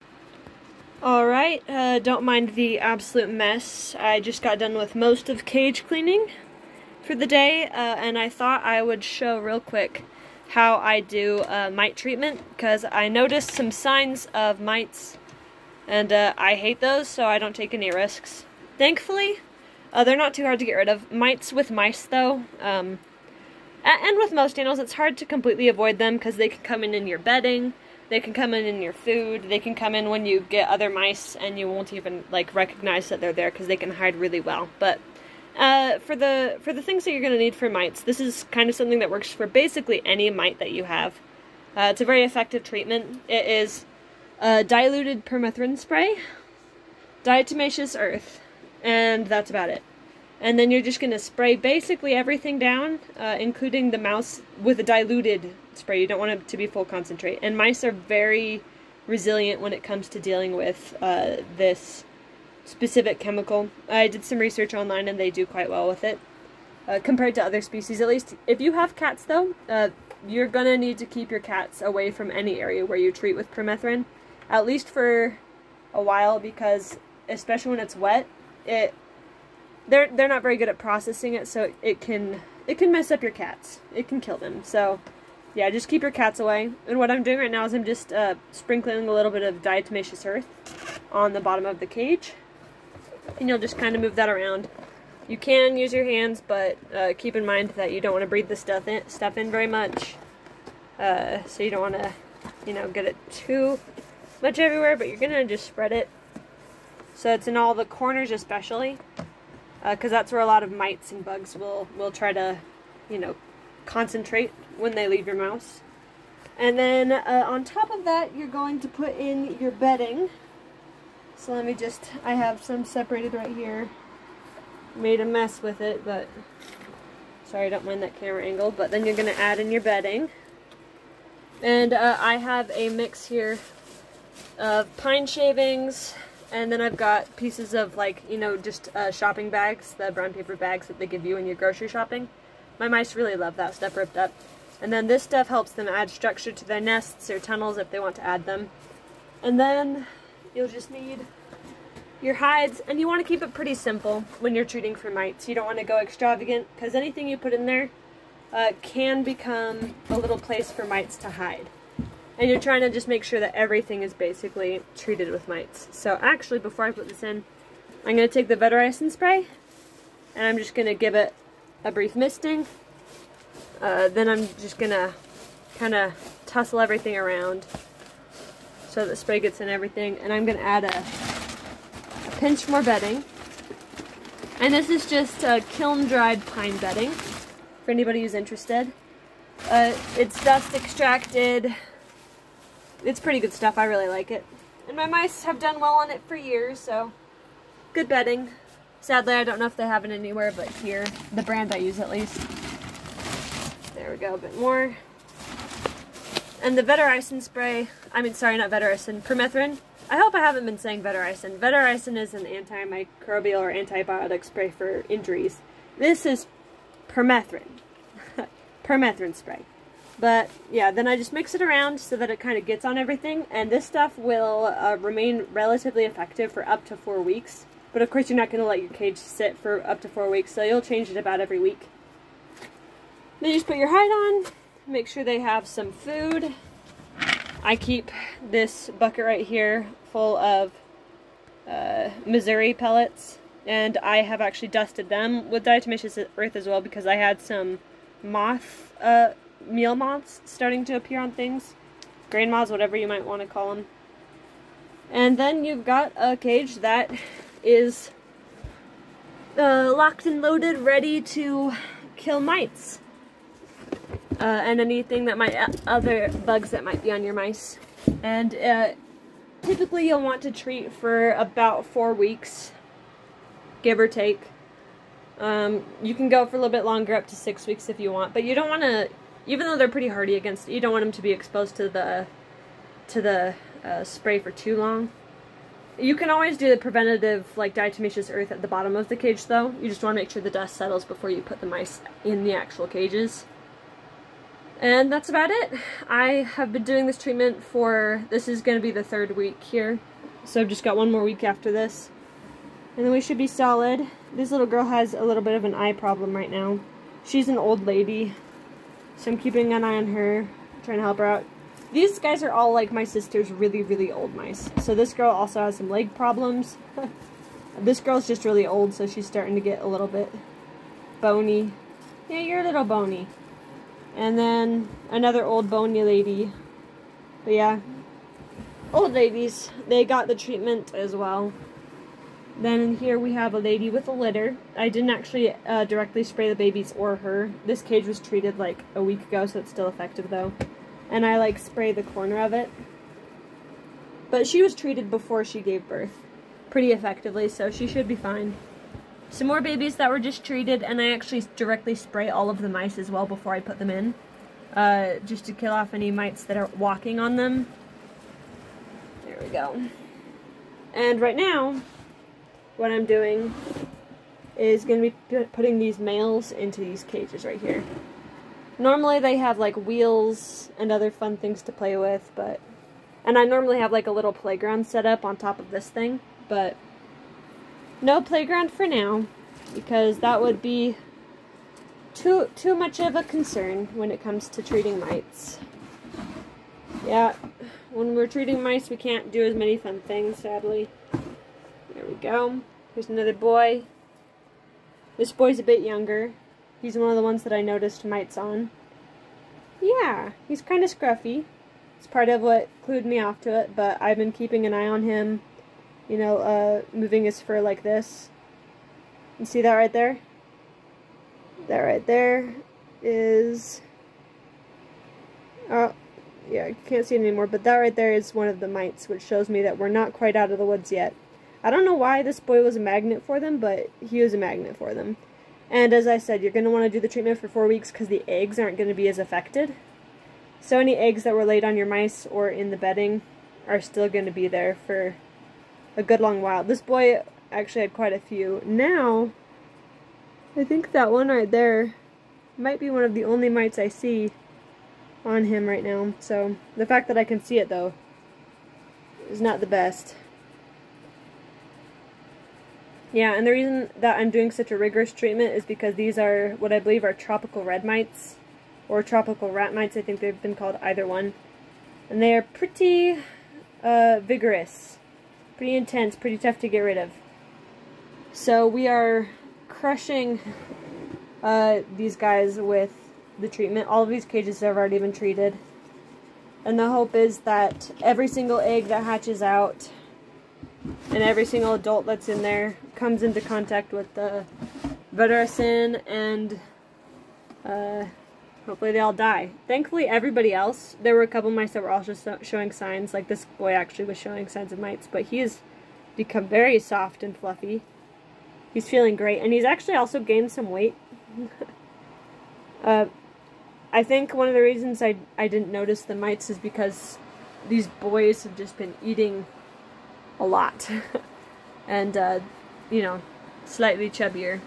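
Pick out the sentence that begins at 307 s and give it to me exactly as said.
She's an old lady so I'm keeping an eye on her, trying to help her out.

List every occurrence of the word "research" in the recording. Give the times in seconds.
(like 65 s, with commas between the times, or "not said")
64 s.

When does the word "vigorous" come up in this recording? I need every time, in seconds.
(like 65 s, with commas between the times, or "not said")
464 s.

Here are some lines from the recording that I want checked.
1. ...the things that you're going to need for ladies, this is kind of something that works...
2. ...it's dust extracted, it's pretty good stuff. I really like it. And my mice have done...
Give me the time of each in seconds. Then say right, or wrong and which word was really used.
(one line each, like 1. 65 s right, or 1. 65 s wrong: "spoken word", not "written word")
1. 36 s wrong: "mites", not "ladies"
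2. 190 s right.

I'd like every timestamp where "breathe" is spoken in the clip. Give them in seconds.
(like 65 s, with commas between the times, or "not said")
98 s.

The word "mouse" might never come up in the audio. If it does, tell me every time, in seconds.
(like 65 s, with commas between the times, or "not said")
53 s, 115 s.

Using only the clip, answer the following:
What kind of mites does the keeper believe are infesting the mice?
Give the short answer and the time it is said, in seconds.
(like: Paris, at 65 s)
Tropical rat mites, at 459 s.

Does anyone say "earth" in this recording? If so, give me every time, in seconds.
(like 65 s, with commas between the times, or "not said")
47 s, 90 s, 246 s, 288 s.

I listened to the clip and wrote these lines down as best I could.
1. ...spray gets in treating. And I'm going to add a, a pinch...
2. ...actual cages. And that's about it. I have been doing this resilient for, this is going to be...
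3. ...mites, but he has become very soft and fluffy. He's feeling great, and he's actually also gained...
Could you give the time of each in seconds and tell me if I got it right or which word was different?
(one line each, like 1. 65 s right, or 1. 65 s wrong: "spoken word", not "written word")
1. 179 s wrong: "everything", not "treating"
2. 292 s wrong: "treatment", not "resilient"
3. 494 s right.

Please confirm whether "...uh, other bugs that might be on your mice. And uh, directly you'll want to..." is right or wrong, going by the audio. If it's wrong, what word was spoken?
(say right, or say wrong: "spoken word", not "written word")
wrong: "typically", not "directly".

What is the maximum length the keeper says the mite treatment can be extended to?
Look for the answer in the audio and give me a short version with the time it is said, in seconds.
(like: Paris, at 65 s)
6 weeks, at 277 s.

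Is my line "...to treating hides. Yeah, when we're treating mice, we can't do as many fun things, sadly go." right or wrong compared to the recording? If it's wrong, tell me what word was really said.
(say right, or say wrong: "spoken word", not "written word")
wrong: "mites", not "hides".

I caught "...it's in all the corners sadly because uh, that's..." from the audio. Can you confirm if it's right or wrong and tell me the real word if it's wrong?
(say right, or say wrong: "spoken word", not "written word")
wrong: "especially", not "sadly".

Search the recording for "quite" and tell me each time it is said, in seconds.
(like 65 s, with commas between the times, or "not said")
65 s, 420 s, 437 s.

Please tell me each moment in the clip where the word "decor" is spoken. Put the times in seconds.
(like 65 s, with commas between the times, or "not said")
not said.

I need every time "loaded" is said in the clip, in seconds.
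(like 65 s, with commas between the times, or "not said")
260 s.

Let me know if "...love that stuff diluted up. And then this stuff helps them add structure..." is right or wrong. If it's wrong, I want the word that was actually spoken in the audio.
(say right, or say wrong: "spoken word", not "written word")
wrong: "ripped", not "diluted".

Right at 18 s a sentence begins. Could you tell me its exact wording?
Thankfully, uh, they're not too hard to get rid of.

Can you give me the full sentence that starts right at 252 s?
Grain moths, whatever you might want to call them.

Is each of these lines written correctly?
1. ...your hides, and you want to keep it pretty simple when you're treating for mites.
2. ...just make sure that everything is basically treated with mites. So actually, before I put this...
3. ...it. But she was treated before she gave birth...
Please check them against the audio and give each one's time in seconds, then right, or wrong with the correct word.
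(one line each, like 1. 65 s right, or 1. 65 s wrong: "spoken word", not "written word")
1. 152 s right
2. 162 s right
3. 342 s right.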